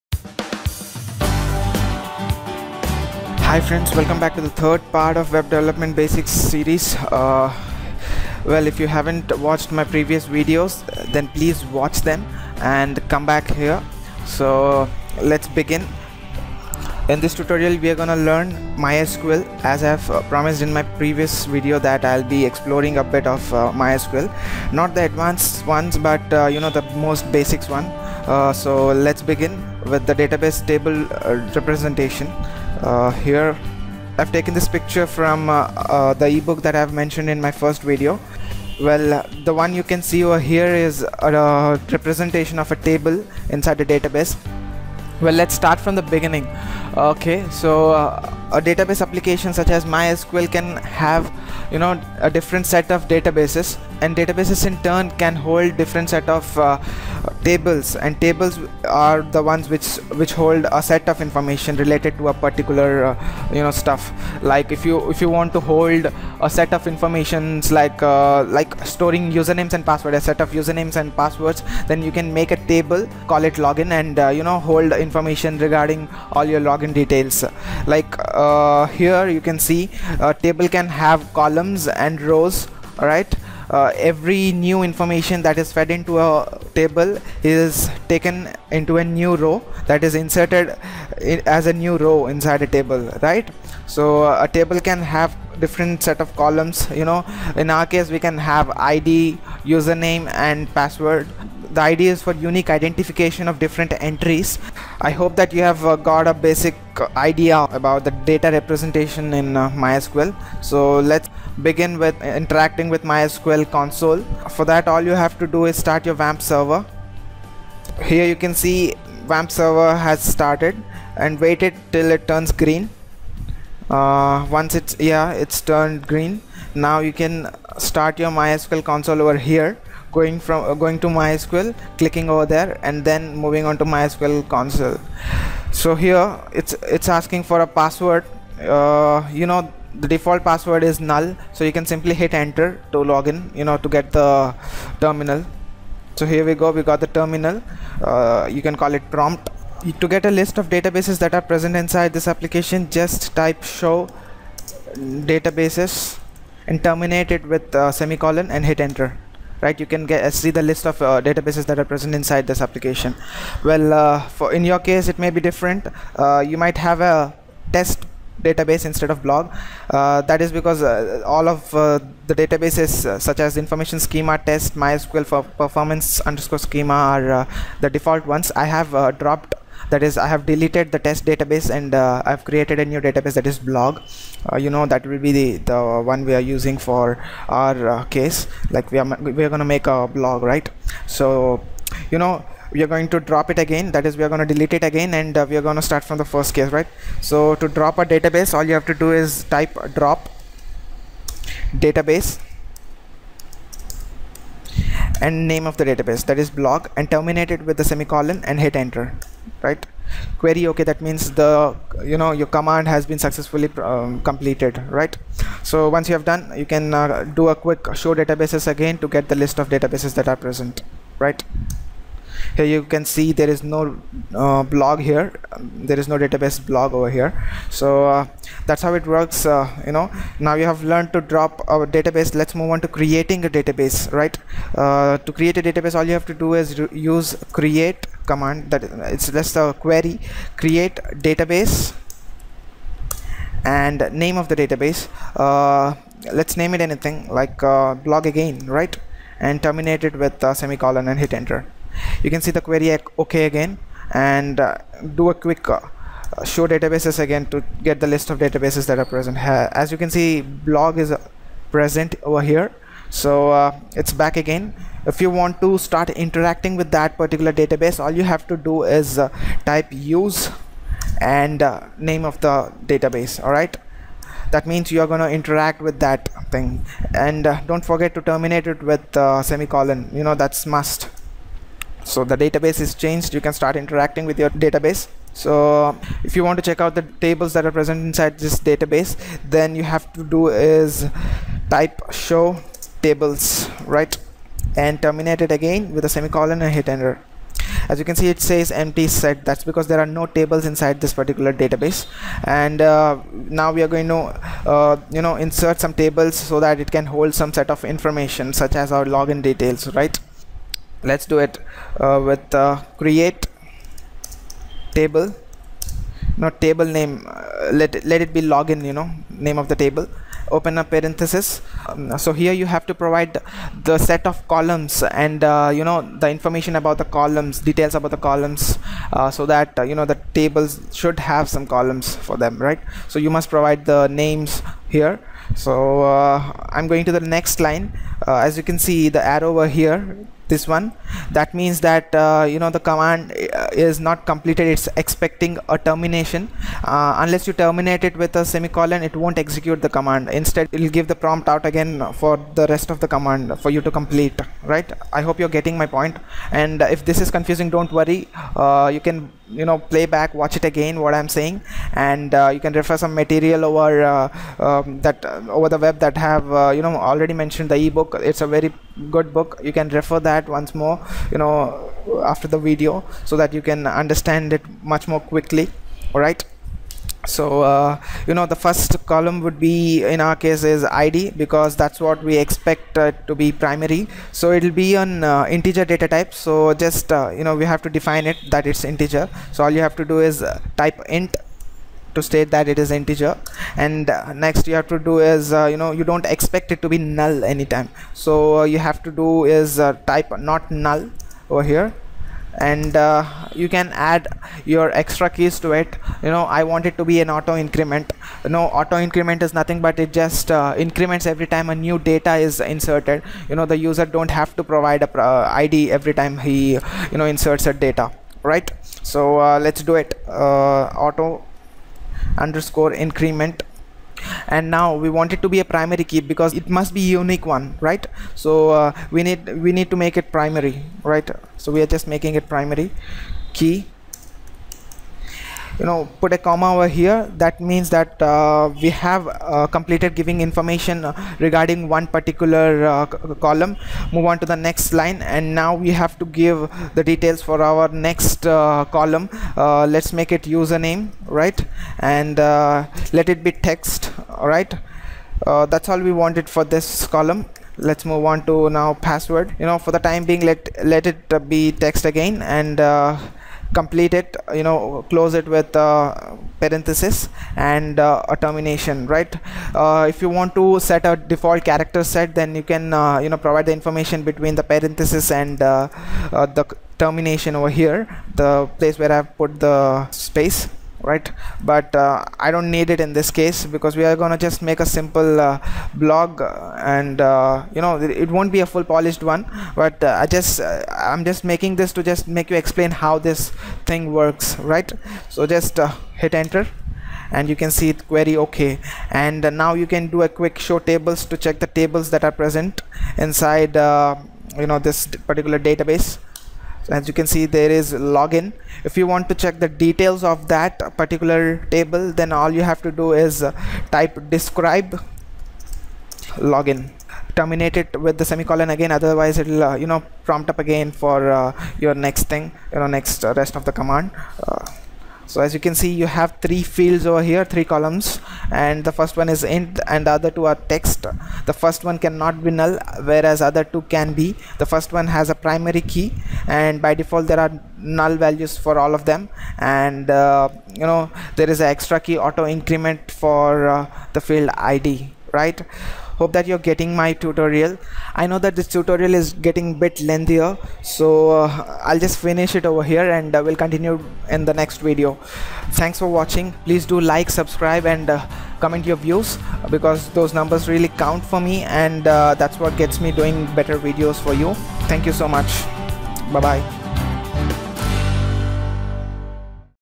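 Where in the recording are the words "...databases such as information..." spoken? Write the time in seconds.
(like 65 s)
172 s.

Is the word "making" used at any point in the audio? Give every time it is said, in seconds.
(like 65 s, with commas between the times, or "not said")
432 s, 491 s.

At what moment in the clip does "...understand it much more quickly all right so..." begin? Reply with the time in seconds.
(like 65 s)
373 s.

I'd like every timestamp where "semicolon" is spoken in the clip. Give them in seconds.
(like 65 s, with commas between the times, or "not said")
157 s, 207 s, 250 s, 279 s, 296 s, 348 s, 518 s.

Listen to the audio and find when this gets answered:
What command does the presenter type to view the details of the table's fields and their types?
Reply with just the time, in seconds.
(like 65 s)
514 s.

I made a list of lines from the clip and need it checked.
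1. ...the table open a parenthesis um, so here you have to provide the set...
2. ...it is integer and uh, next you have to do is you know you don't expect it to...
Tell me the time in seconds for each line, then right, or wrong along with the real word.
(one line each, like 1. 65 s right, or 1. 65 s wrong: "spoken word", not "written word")
1. 319 s right
2. 392 s right.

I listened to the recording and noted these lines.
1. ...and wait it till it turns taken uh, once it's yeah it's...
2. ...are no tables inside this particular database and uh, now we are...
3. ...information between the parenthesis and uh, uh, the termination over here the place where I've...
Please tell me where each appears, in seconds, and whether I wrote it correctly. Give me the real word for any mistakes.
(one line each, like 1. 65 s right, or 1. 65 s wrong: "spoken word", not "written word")
1. 121 s wrong: "green", not "taken"
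2. 299 s right
3. 473 s right.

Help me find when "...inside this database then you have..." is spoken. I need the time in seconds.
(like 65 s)
288 s.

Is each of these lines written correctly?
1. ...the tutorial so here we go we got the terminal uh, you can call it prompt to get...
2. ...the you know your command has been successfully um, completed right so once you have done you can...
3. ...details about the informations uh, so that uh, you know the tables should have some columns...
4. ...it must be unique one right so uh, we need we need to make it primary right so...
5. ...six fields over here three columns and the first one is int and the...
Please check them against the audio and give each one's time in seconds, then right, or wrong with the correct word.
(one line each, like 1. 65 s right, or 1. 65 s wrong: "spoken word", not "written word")
1. 144 s wrong: "terminal", not "tutorial"
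2. 211 s right
3. 327 s wrong: "columns", not "informations"
4. 426 s right
5. 526 s wrong: "three", not "six".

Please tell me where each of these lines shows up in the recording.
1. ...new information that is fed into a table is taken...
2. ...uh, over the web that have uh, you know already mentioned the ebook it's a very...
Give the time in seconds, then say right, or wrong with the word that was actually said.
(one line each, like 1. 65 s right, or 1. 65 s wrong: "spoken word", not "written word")
1. 84 s right
2. 365 s right.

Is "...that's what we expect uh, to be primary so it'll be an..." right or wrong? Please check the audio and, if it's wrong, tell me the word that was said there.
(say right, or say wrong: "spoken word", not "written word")
right.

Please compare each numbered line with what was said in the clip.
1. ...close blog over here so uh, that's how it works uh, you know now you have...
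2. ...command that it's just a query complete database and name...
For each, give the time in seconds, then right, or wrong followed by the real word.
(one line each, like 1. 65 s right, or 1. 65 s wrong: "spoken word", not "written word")
1. 226 s wrong: "database", not "close"
2. 238 s wrong: "create", not "complete".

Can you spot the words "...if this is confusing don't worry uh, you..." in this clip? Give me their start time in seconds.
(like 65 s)
356 s.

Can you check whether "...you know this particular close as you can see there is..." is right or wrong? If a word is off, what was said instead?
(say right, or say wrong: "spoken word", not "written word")
wrong: "database", not "close".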